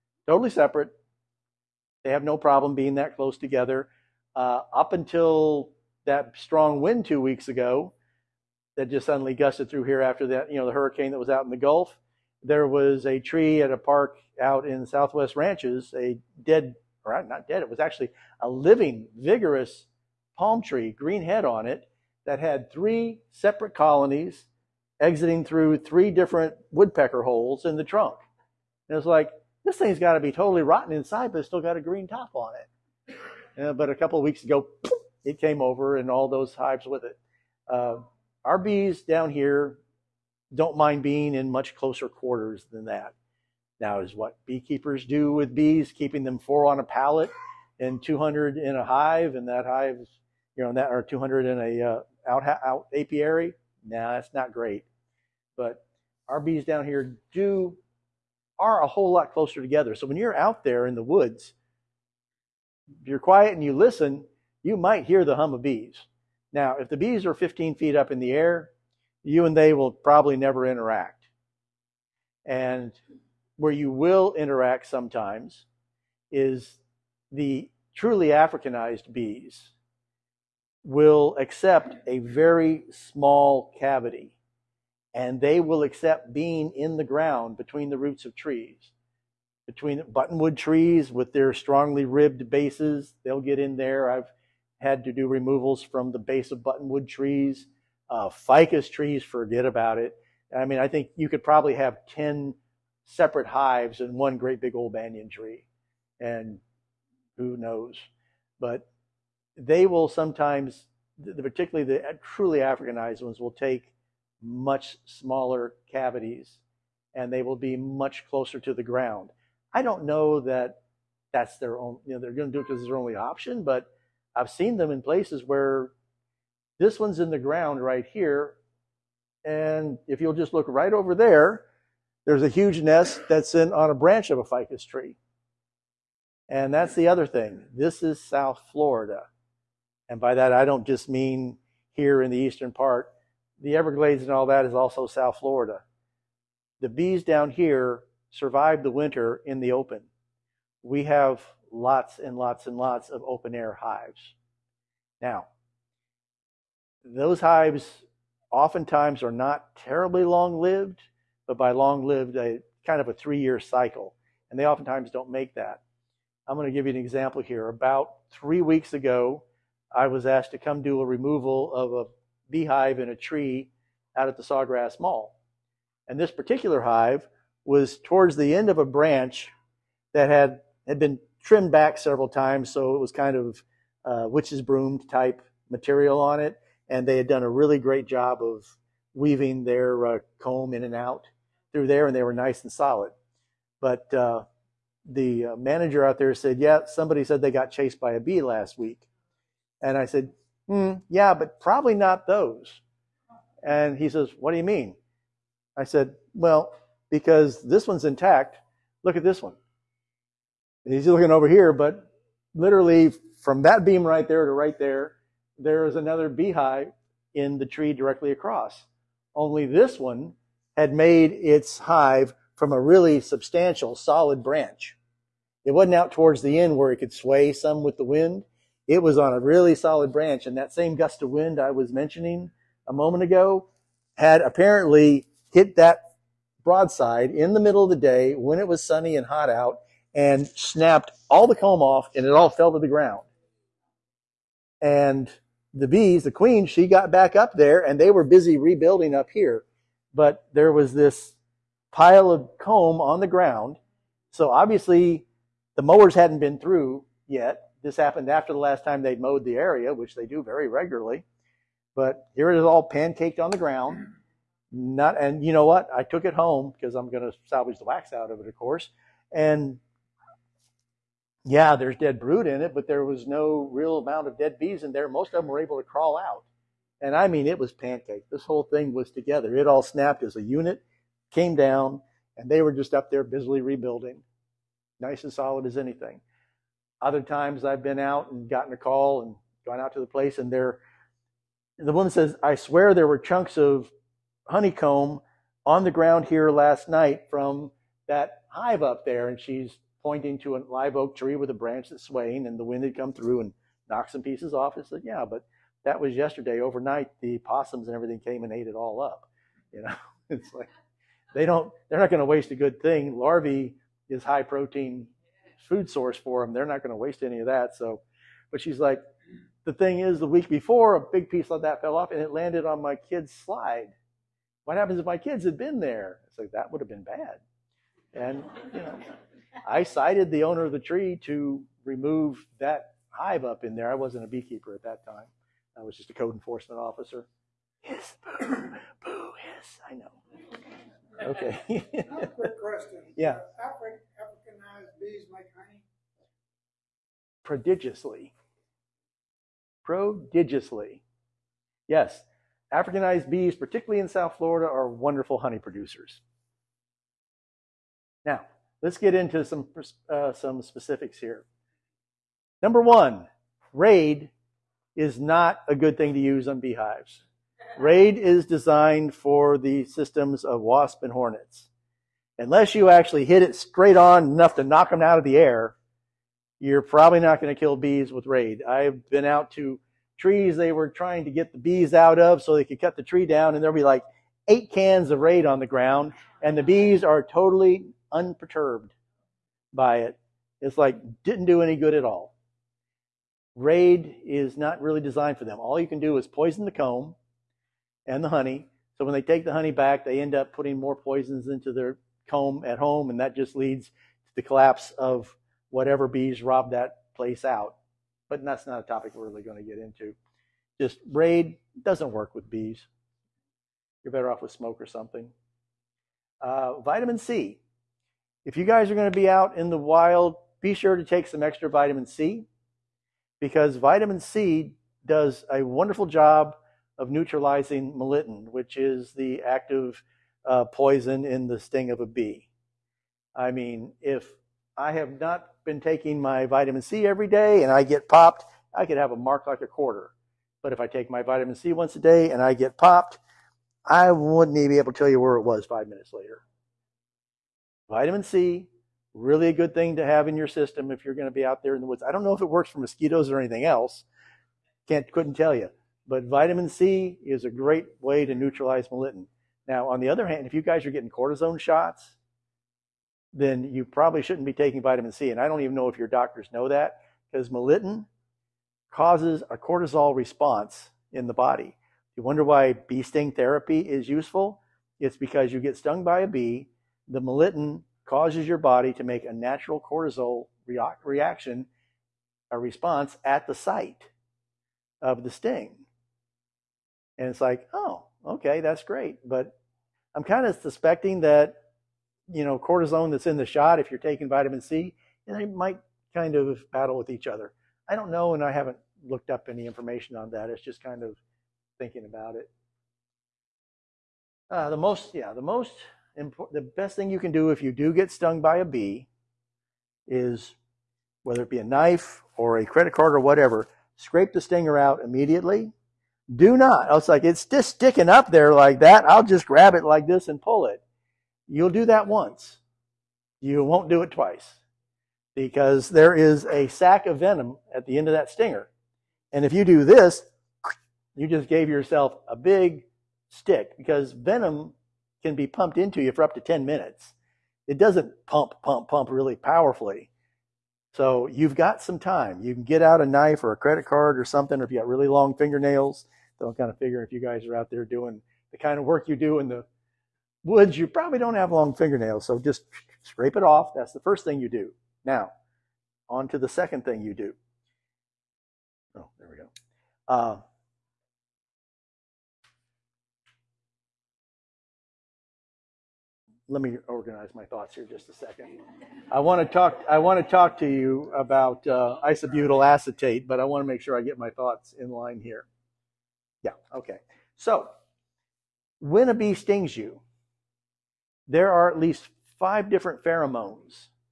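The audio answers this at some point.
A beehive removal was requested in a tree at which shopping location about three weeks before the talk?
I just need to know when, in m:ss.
2:54.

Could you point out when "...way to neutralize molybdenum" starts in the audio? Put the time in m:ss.
7:38.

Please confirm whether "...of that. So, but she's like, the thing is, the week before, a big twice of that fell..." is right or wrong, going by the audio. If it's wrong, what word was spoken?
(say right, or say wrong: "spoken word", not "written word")
wrong: "piece", not "twice".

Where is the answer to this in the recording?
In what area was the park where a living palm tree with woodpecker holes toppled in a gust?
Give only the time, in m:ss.
0:14.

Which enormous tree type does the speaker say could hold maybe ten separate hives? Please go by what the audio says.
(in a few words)
banyan tree.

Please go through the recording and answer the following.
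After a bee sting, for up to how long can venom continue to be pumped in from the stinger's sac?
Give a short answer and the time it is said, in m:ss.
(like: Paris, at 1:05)
10 minutes, at 8:56.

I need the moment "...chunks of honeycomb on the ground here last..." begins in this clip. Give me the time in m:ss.
4:53.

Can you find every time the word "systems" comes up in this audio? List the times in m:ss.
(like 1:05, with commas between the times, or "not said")
6:09, 7:30.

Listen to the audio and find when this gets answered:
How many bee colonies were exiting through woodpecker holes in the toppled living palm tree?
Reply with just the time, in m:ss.
0:22.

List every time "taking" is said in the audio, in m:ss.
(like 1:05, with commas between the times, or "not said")
7:15, 7:44, 8:14.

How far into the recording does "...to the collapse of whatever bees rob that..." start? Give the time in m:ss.
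6:43.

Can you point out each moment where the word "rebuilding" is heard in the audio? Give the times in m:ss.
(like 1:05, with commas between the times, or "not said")
4:08, 4:43.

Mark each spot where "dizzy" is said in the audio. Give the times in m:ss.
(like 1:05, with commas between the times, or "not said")
not said.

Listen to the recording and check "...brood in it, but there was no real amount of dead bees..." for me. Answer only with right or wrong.
right.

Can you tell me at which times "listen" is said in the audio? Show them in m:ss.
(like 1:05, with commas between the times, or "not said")
1:03.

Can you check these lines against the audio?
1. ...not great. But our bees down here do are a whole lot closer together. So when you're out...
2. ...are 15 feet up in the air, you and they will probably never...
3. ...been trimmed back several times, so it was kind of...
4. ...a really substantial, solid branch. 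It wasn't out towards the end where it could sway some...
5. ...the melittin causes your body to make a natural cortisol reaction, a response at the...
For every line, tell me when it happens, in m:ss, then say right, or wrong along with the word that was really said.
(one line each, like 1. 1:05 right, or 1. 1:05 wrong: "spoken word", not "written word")
1. 0:54 right
2. 1:07 right
3. 3:00 right
4. 3:42 right
5. 7:57 right.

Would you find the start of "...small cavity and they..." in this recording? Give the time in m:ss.
1:22.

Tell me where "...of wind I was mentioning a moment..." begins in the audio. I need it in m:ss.
3:51.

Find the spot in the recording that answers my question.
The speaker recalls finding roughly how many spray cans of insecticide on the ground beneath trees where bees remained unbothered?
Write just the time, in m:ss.
6:24.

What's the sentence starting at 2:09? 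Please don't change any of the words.
And if you'll just look right over there, there's a huge nest that's in on a branch of a ficus tree.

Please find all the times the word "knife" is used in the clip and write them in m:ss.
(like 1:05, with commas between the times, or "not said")
8:31, 9:03.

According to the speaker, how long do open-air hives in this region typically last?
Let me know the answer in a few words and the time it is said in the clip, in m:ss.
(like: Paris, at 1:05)
3 years, at 2:43.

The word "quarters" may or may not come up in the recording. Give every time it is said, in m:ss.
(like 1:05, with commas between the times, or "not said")
0:42, 7:19.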